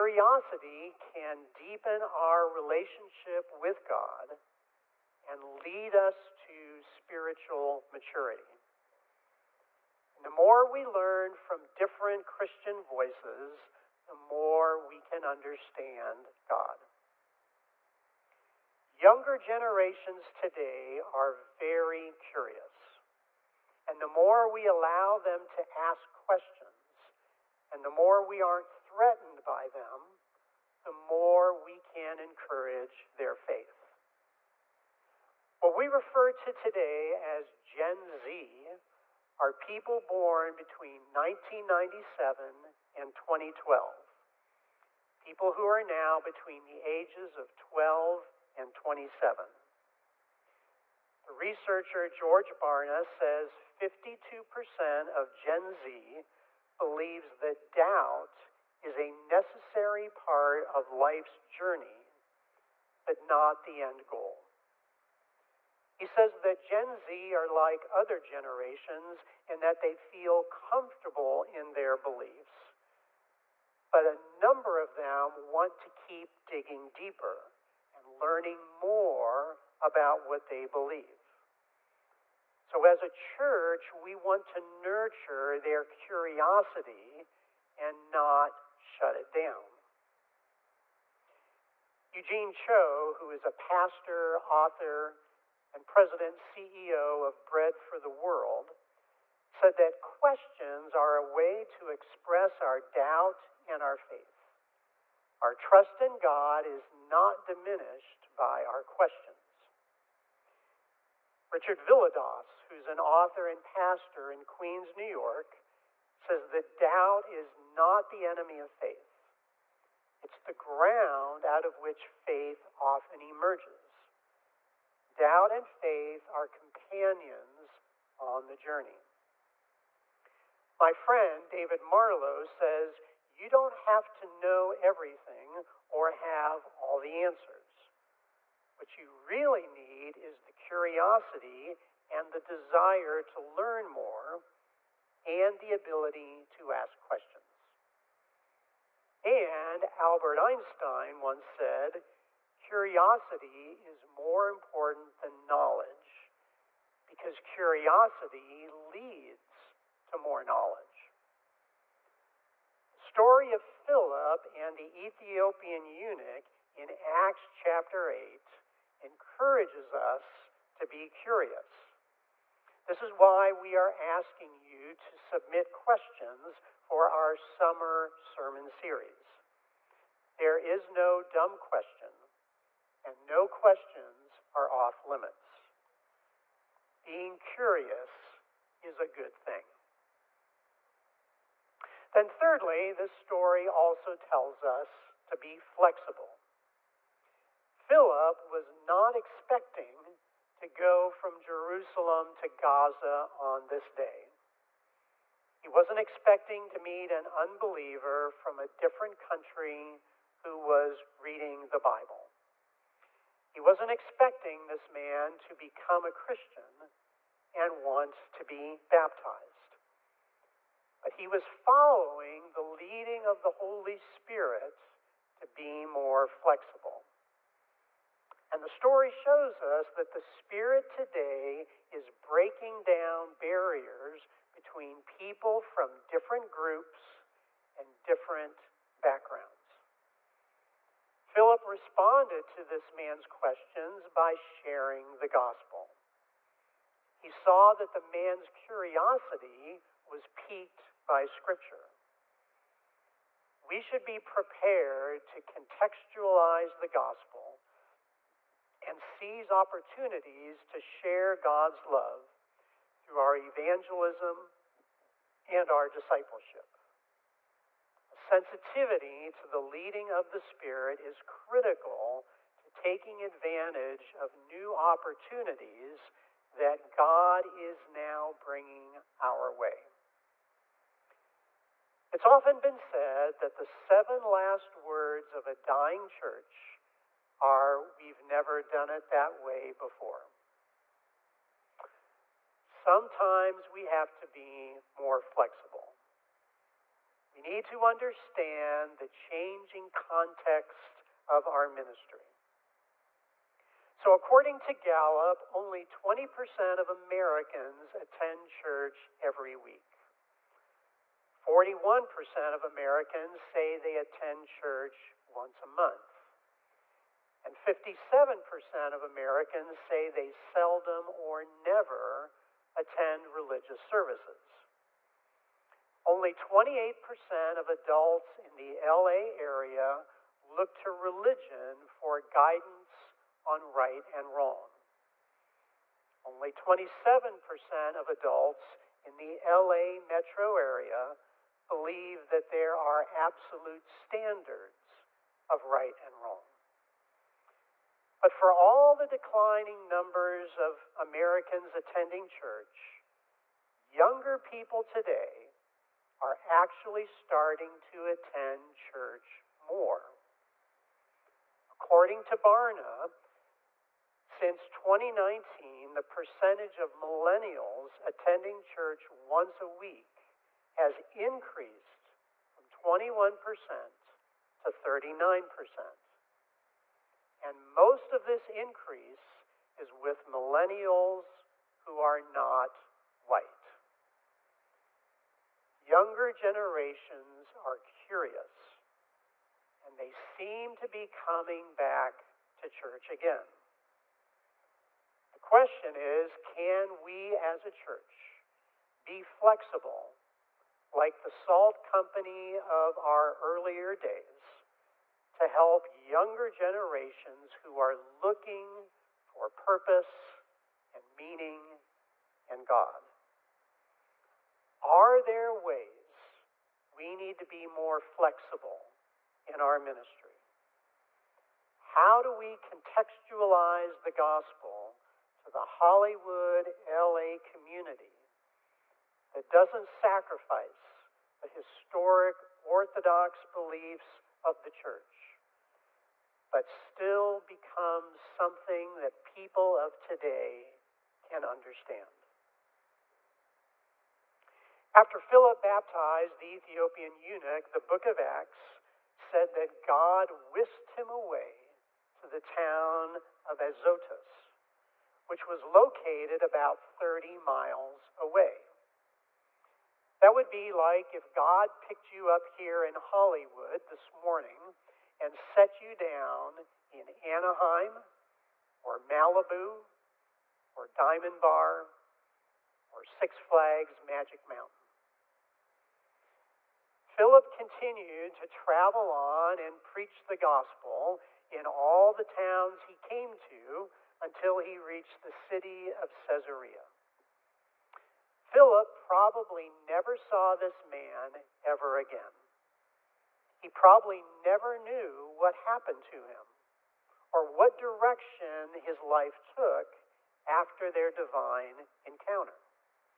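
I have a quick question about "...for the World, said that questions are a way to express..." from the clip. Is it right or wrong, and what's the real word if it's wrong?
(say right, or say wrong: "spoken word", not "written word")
right.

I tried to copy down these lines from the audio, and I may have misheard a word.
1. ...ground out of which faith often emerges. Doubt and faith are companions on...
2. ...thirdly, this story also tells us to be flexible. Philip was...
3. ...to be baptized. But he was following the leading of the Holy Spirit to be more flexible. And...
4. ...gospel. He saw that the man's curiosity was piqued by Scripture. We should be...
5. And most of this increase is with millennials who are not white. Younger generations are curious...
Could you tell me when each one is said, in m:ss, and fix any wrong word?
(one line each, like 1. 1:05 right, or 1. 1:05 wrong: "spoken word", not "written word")
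1. 2:00 right
2. 3:12 right
3. 3:38 right
4. 4:05 right
5. 6:17 right.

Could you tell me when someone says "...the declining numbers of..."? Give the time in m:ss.
5:48.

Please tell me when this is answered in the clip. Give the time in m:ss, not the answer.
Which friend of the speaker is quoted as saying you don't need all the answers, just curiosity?
2:11.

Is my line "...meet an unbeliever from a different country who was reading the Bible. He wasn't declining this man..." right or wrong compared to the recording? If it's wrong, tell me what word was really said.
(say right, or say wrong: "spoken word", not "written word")
wrong: "expecting", not "declining".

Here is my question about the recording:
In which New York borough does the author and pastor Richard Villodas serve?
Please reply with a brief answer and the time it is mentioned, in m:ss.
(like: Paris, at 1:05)
Queens, at 1:54.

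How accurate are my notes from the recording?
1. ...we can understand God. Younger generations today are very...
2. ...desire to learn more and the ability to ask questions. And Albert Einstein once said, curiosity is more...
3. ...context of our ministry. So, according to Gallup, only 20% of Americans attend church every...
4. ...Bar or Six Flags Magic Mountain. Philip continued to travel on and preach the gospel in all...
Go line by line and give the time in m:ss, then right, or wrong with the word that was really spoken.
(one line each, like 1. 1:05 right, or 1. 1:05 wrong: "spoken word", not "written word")
1. 0:14 right
2. 2:22 right
3. 4:59 right
4. 7:51 right.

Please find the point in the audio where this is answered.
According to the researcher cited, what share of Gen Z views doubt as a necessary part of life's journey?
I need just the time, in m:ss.
0:53.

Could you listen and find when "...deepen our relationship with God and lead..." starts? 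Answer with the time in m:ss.
0:01.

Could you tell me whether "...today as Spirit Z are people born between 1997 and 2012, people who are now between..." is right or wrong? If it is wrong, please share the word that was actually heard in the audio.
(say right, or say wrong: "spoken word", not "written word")
wrong: "Gen", not "Spirit".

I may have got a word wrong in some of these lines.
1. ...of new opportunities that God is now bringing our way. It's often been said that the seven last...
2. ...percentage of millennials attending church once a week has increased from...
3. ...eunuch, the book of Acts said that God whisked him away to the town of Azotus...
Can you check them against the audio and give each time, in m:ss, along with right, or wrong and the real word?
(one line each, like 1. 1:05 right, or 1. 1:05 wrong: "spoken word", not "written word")
1. 4:34 right
2. 6:06 right
3. 7:27 right.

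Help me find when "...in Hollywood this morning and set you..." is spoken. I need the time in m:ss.
7:42.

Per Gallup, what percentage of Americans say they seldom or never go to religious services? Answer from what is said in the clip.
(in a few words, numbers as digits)
57%.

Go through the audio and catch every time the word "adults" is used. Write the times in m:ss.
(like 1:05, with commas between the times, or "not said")
5:27, 5:38.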